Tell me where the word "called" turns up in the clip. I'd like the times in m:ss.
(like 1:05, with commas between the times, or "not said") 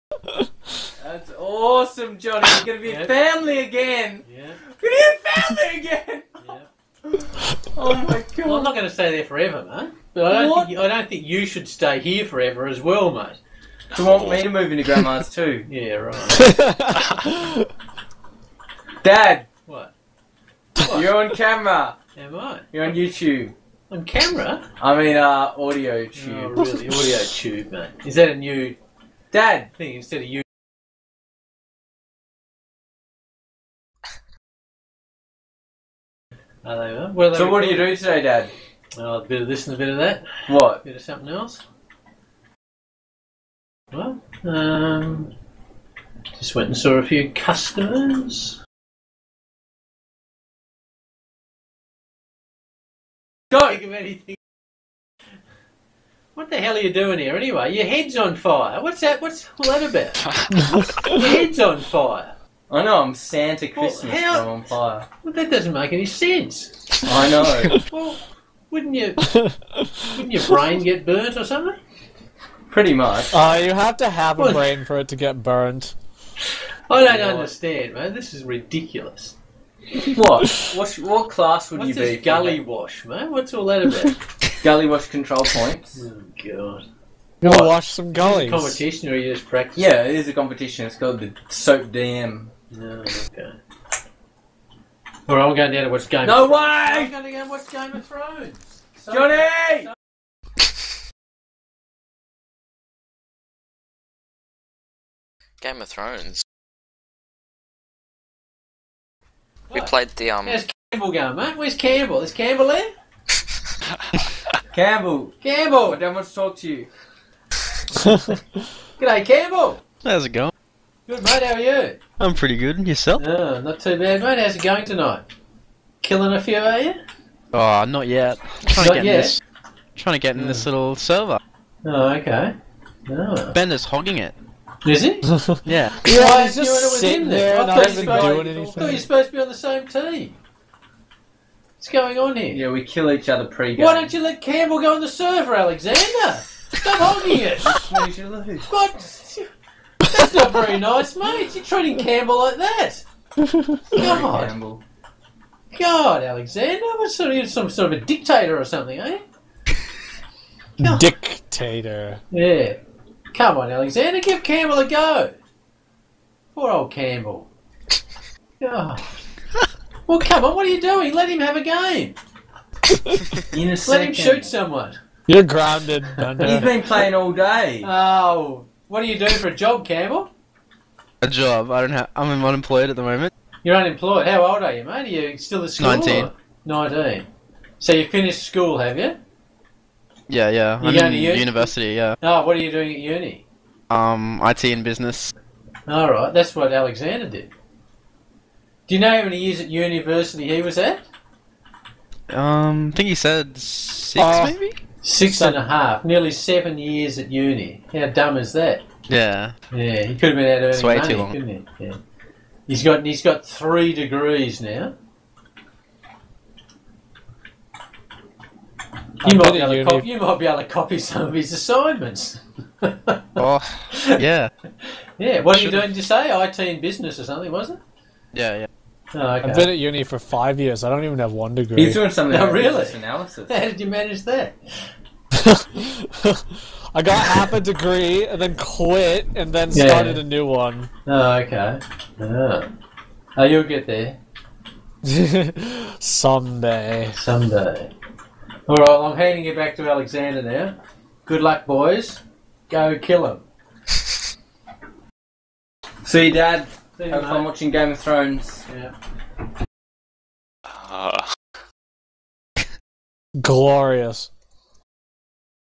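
1:30.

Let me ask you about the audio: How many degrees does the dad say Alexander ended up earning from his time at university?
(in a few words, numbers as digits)
3.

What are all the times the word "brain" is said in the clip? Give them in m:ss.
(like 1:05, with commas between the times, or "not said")
1:10, 1:14.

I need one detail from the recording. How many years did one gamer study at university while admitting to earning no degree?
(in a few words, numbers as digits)
5 years.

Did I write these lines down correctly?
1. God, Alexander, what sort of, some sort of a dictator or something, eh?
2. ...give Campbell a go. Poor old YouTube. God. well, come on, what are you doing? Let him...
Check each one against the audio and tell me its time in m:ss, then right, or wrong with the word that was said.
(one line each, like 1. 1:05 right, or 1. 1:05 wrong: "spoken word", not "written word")
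1. 2:35 right
2. 2:44 wrong: "Campbell", not "YouTube".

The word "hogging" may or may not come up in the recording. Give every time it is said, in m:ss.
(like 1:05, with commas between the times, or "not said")
2:13, 2:26.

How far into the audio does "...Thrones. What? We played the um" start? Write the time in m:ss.
1:45.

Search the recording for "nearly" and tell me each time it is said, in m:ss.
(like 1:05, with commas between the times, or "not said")
3:26.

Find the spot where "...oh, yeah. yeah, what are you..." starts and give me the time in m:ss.
3:43.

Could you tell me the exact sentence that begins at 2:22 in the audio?
Yeah, we kill each other pre-game.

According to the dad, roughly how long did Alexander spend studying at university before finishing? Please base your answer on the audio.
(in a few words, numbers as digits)
6 and a half years.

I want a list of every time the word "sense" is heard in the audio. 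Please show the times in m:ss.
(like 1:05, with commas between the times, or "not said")
1:06.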